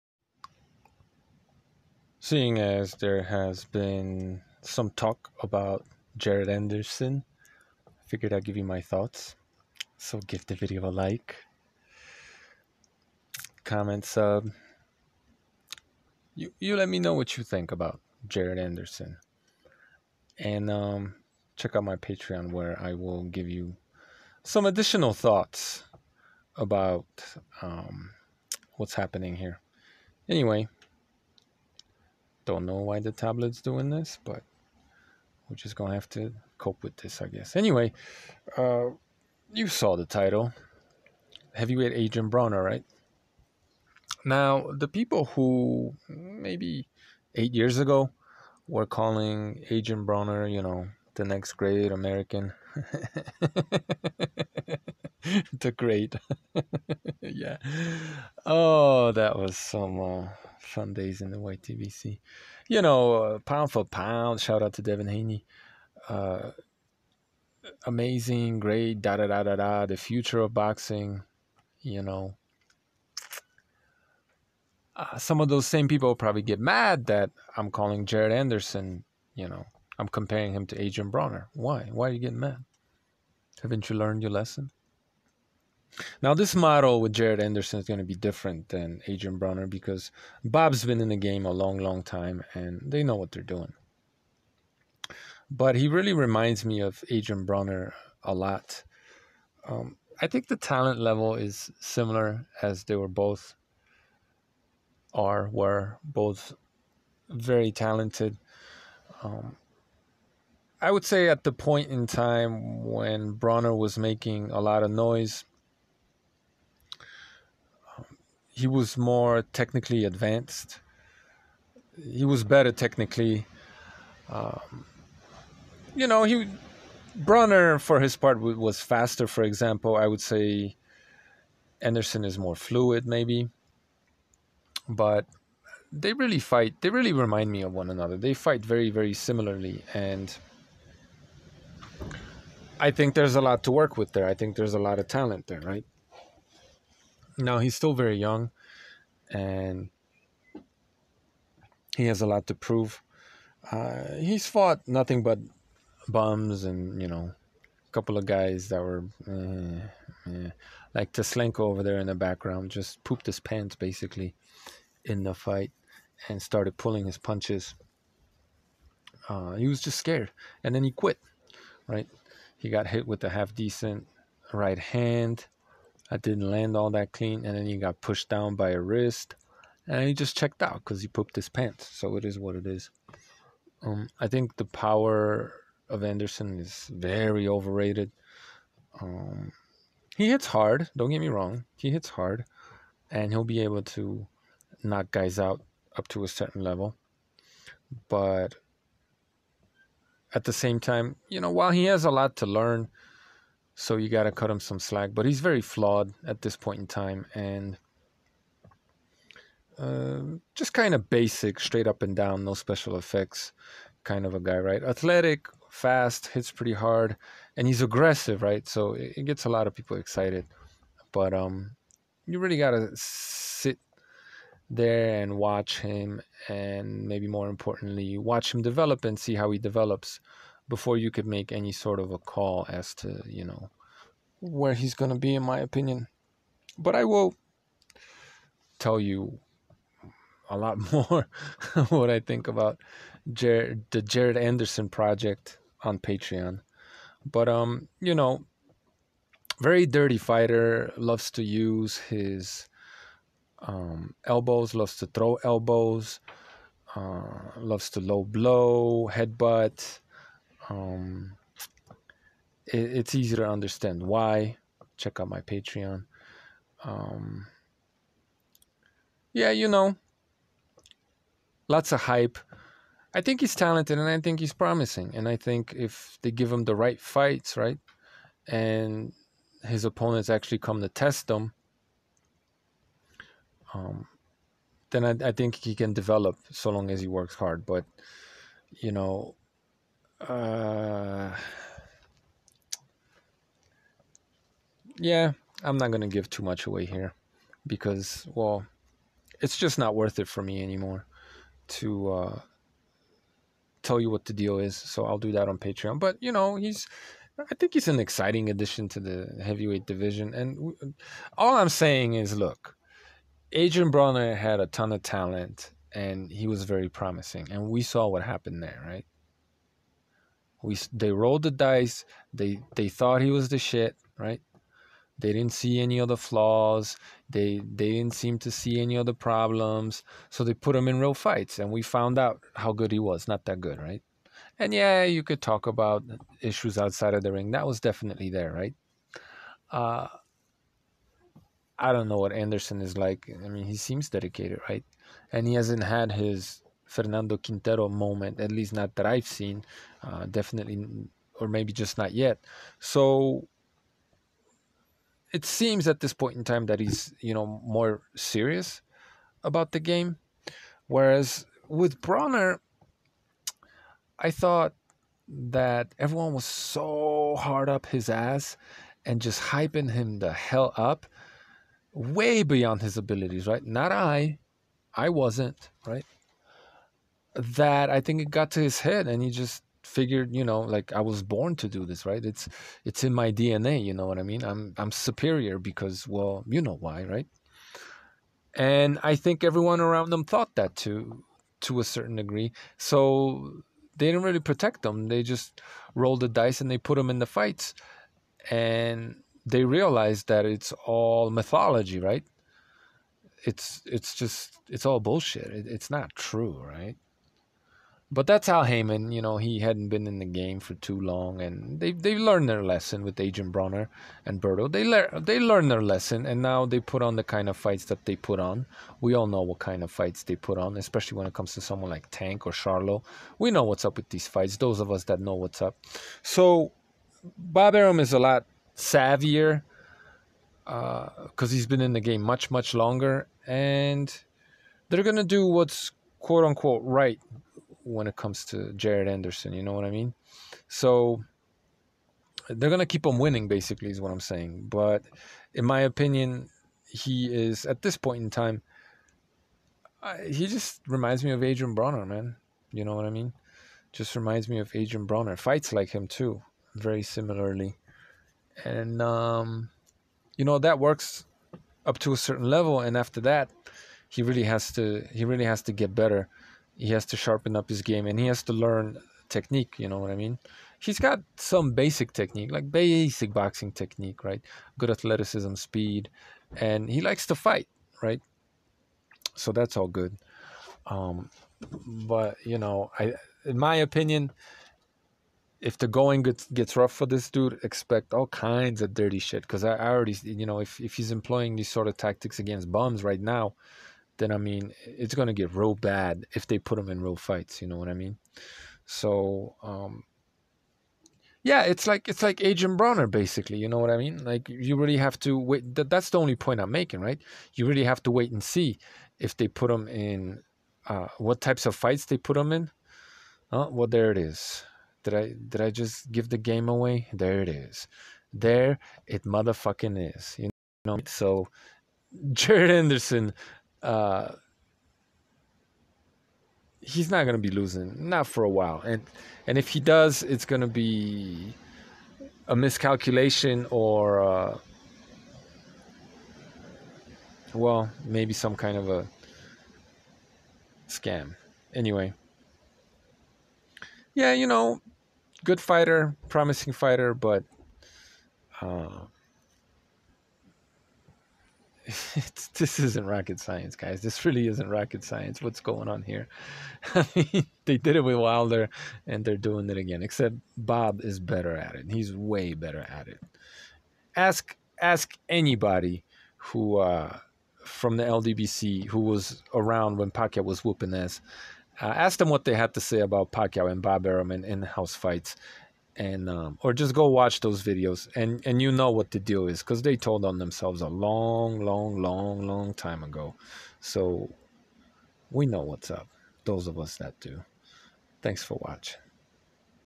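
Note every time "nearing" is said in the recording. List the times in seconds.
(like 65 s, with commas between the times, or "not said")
not said.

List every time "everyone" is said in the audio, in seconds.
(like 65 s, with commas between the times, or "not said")
365 s, 389 s.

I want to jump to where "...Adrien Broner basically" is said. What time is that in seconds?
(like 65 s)
502 s.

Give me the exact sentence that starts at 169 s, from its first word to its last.
Uh, he was just scared and then he quit, right?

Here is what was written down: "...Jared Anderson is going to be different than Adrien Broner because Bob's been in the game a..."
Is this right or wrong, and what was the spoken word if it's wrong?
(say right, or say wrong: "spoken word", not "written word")
right.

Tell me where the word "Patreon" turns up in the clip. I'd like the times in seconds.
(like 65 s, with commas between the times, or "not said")
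21 s, 245 s, 265 s, 305 s.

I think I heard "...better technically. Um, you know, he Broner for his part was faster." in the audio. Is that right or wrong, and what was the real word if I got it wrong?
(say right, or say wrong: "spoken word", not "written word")
right.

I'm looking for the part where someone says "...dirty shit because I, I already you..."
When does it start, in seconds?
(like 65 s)
488 s.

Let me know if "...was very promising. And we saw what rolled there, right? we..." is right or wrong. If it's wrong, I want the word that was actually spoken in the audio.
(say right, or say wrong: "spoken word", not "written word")
wrong: "happened", not "rolled".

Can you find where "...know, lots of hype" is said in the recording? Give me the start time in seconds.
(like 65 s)
269 s.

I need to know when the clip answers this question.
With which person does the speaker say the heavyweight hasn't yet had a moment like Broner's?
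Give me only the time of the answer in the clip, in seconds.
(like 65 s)
346 s.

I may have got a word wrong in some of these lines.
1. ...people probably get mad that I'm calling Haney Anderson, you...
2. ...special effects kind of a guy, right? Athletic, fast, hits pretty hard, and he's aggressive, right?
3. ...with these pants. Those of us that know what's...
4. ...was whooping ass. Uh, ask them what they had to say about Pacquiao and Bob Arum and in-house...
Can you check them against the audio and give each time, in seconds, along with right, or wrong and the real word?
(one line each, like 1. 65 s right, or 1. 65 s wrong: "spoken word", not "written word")
1. 75 s wrong: "Jared", not "Haney"
2. 212 s right
3. 423 s wrong: "fights", not "pants"
4. 570 s right.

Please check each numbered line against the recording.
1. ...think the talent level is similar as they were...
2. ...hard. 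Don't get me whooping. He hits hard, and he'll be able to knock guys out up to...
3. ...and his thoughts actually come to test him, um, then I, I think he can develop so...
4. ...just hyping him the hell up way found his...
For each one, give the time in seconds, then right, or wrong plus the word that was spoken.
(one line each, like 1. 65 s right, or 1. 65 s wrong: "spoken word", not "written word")
1. 100 s right
2. 190 s wrong: "wrong", not "whooping"
3. 278 s wrong: "opponents", not "thoughts"
4. 369 s wrong: "beyond", not "found".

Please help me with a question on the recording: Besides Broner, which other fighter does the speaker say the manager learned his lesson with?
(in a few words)
Berto.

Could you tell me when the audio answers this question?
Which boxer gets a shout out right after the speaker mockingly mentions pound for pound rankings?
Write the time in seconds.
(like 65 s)
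64 s.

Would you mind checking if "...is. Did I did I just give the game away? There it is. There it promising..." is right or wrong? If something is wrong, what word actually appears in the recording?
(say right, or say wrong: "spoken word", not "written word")
wrong: "motherfucking", not "promising".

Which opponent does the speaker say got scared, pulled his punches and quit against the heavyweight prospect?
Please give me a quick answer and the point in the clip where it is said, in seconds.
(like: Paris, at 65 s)
Teslenko, at 161 s.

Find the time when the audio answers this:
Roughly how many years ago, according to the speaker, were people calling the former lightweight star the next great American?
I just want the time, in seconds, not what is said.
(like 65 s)
47 s.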